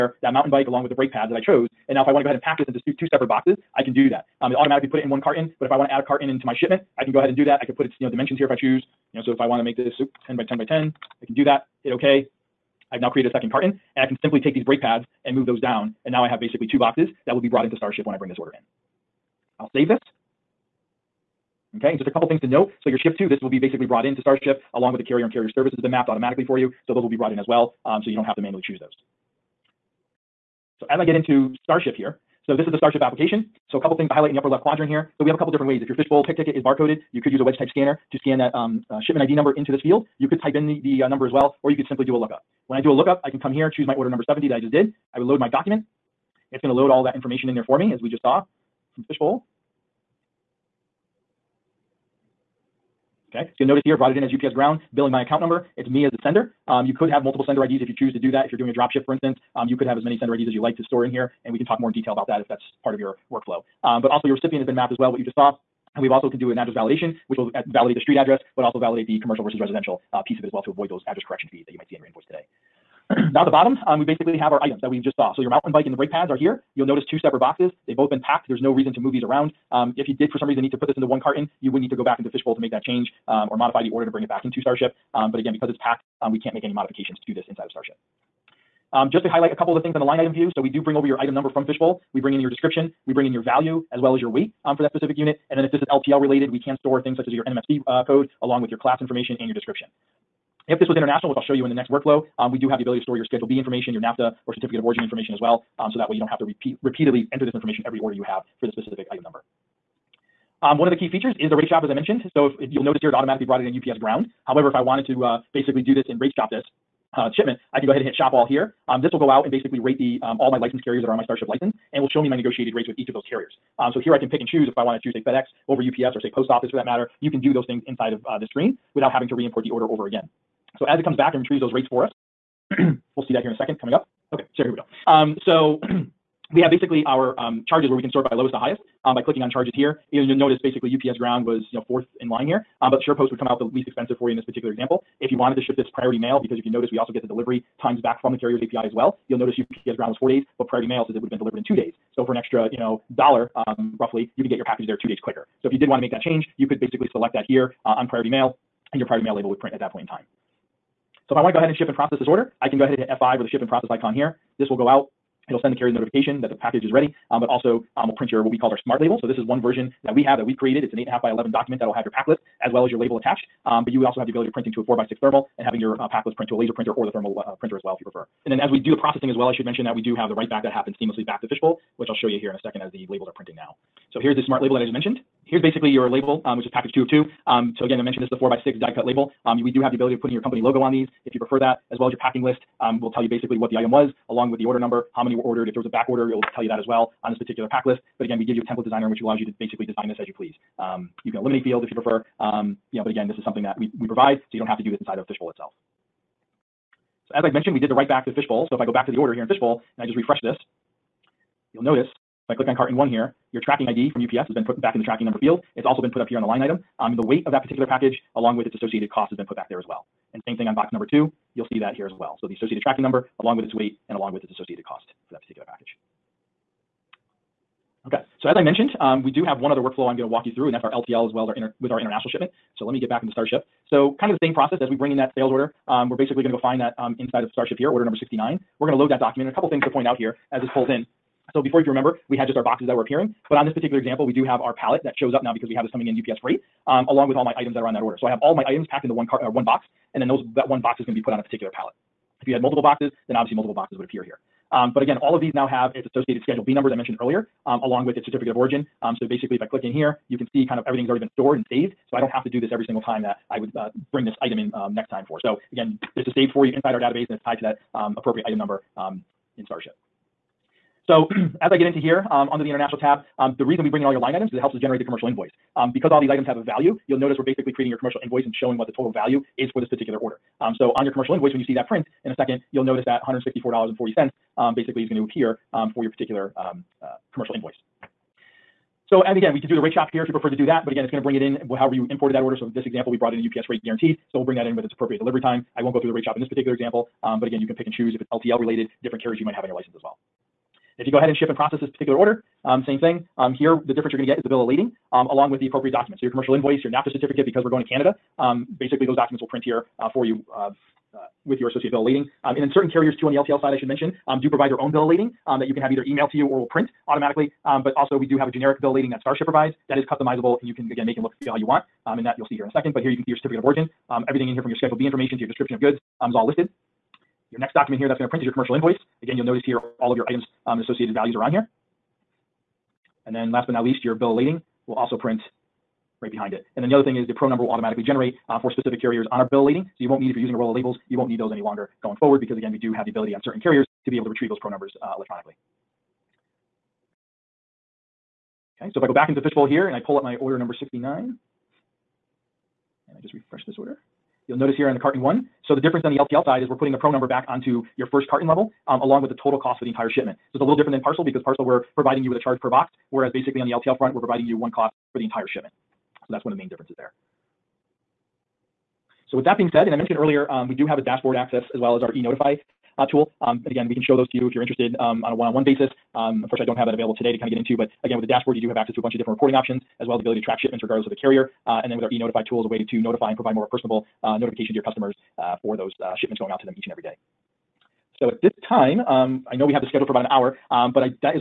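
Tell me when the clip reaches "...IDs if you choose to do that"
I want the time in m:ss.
0:57.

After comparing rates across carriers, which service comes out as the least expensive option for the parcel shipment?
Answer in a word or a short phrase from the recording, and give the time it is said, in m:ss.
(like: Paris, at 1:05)
SurePost, at 2:23.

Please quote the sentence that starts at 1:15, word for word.
So your mountain bike and the brake pads are here.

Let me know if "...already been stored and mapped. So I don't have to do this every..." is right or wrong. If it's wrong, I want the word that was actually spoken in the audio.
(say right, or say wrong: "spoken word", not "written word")
wrong: "saved", not "mapped".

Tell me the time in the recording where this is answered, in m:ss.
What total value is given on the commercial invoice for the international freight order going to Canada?
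4:43.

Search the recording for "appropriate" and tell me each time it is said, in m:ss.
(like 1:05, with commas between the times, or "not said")
4:28, 4:54, 5:05.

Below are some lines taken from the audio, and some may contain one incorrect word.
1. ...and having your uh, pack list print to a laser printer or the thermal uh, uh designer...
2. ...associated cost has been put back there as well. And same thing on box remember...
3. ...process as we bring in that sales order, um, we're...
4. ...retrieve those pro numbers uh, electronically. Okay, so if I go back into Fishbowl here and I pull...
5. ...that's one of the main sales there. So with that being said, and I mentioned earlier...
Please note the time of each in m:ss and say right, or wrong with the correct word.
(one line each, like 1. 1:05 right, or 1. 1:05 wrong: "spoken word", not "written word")
1. 2:55 wrong: "printer", not "designer"
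2. 3:38 wrong: "number", not "remember"
3. 3:54 right
4. 5:44 right
5. 6:06 wrong: "differences", not "sales".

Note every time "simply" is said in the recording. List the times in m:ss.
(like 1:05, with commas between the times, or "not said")
0:14, 0:41.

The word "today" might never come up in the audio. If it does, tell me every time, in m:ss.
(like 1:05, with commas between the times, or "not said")
1:12, 6:17.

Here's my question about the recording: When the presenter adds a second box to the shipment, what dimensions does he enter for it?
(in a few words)
10 by 10 by 10.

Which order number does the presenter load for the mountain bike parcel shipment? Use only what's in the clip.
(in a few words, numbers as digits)
70.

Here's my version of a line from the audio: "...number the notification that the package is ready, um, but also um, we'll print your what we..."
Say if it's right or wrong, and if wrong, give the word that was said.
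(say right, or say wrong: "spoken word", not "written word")
wrong: "carrier", not "number".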